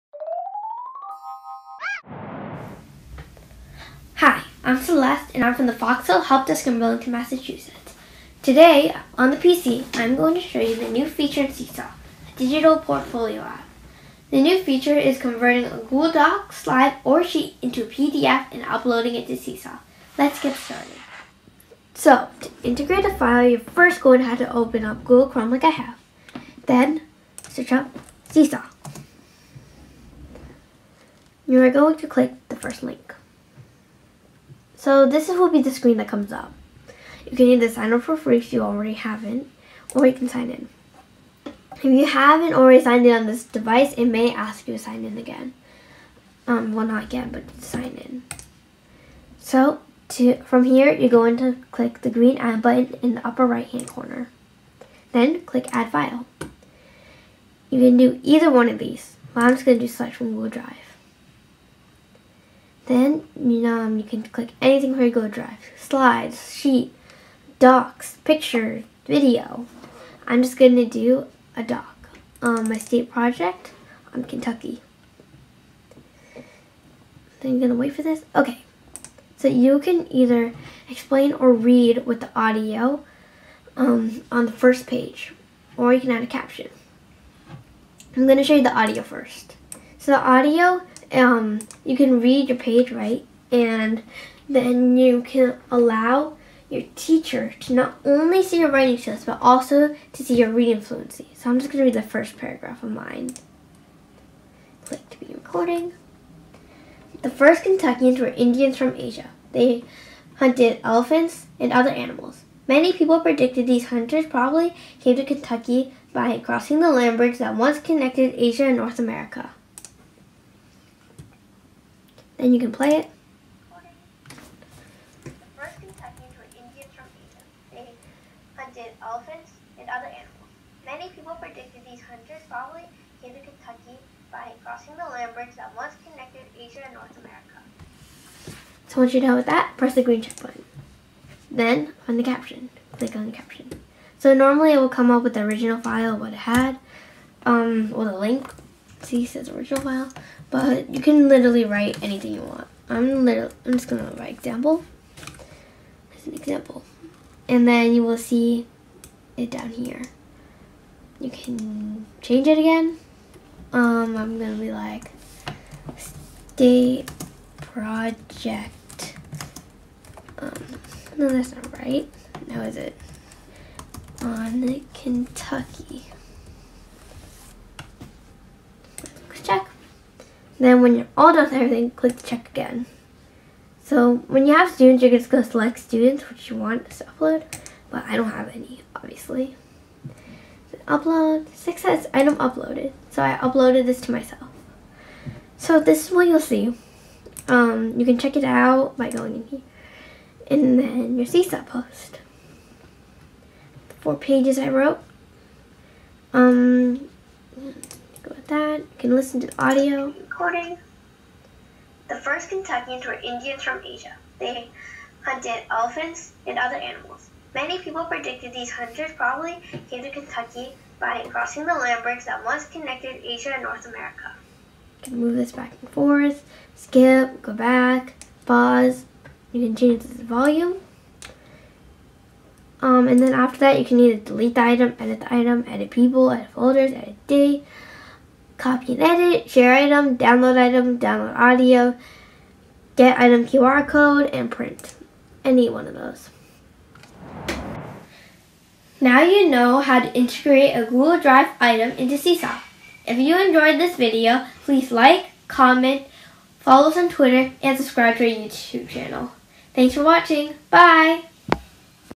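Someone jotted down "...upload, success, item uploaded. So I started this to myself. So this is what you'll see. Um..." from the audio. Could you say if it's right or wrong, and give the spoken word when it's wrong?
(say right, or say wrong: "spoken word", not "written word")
wrong: "uploaded", not "started".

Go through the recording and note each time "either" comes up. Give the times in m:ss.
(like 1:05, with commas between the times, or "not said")
0:37, 0:58, 1:20, 3:53.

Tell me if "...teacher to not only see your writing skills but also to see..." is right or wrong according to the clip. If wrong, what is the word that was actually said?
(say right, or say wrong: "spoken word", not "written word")
right.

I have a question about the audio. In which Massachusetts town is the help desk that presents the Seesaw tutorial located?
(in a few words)
Burlington.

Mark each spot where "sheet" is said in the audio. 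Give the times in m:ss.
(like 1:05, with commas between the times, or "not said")
0:17, 1:06.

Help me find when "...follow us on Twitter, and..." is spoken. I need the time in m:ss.
4:16.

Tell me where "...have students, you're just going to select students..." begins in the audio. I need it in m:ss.
3:04.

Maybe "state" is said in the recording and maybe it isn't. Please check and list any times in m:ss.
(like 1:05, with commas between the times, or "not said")
1:12, 2:45.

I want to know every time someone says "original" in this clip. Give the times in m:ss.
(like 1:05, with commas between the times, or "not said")
2:25, 2:29.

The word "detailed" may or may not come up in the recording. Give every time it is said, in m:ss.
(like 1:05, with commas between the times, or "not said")
not said.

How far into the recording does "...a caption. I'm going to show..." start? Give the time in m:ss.
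1:26.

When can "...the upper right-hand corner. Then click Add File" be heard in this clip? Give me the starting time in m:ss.
0:53.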